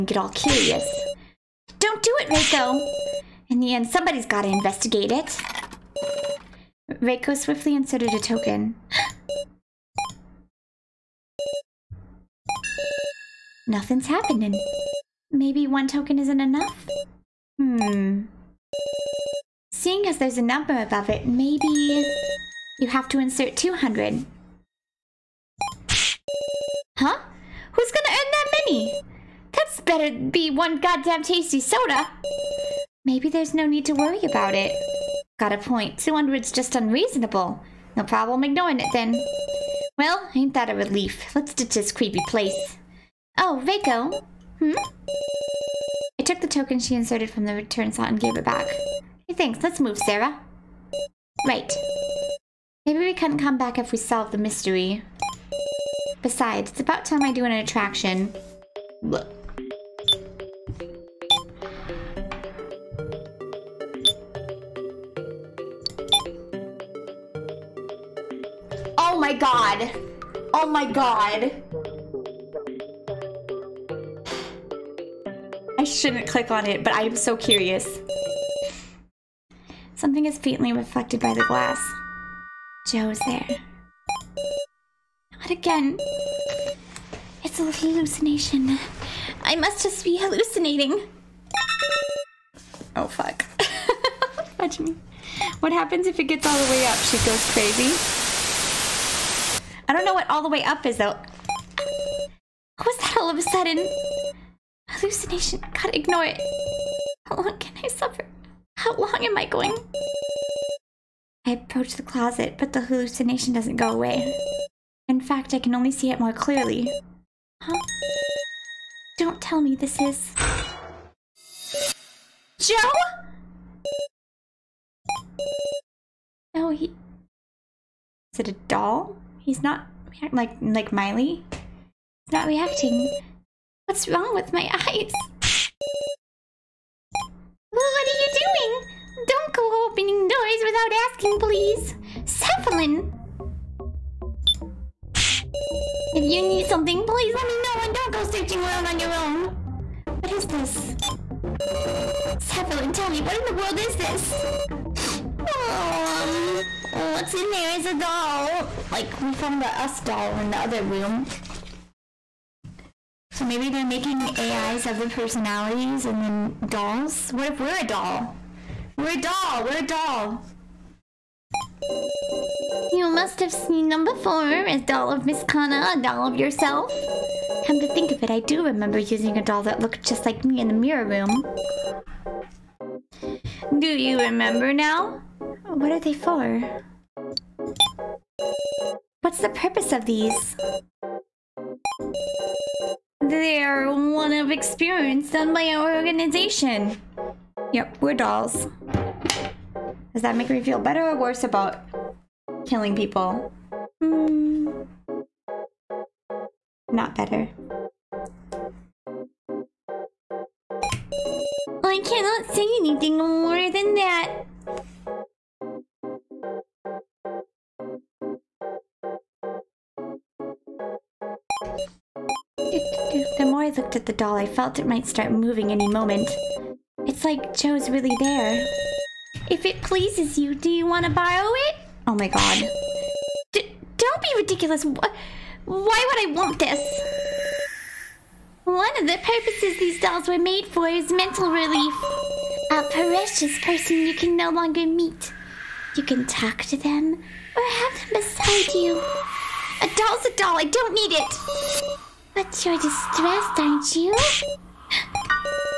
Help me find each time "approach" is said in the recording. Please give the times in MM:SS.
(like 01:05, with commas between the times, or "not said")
01:51.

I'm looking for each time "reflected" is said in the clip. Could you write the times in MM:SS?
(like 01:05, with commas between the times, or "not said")
01:20.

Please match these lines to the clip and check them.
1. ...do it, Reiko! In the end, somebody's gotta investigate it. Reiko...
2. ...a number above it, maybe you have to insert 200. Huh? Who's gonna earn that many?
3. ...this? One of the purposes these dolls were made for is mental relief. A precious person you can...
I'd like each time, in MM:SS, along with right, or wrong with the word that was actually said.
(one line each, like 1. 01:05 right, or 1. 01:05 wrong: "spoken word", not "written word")
1. 00:02 right
2. 00:20 right
3. 03:56 right.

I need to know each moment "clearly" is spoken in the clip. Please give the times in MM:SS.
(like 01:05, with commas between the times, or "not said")
01:56.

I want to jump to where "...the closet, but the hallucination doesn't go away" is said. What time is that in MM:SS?
01:51.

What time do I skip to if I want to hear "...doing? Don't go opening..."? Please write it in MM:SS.
02:18.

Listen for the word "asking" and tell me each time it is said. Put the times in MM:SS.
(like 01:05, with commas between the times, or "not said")
02:21.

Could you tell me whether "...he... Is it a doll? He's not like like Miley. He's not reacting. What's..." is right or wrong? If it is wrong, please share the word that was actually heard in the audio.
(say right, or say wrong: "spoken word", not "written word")
right.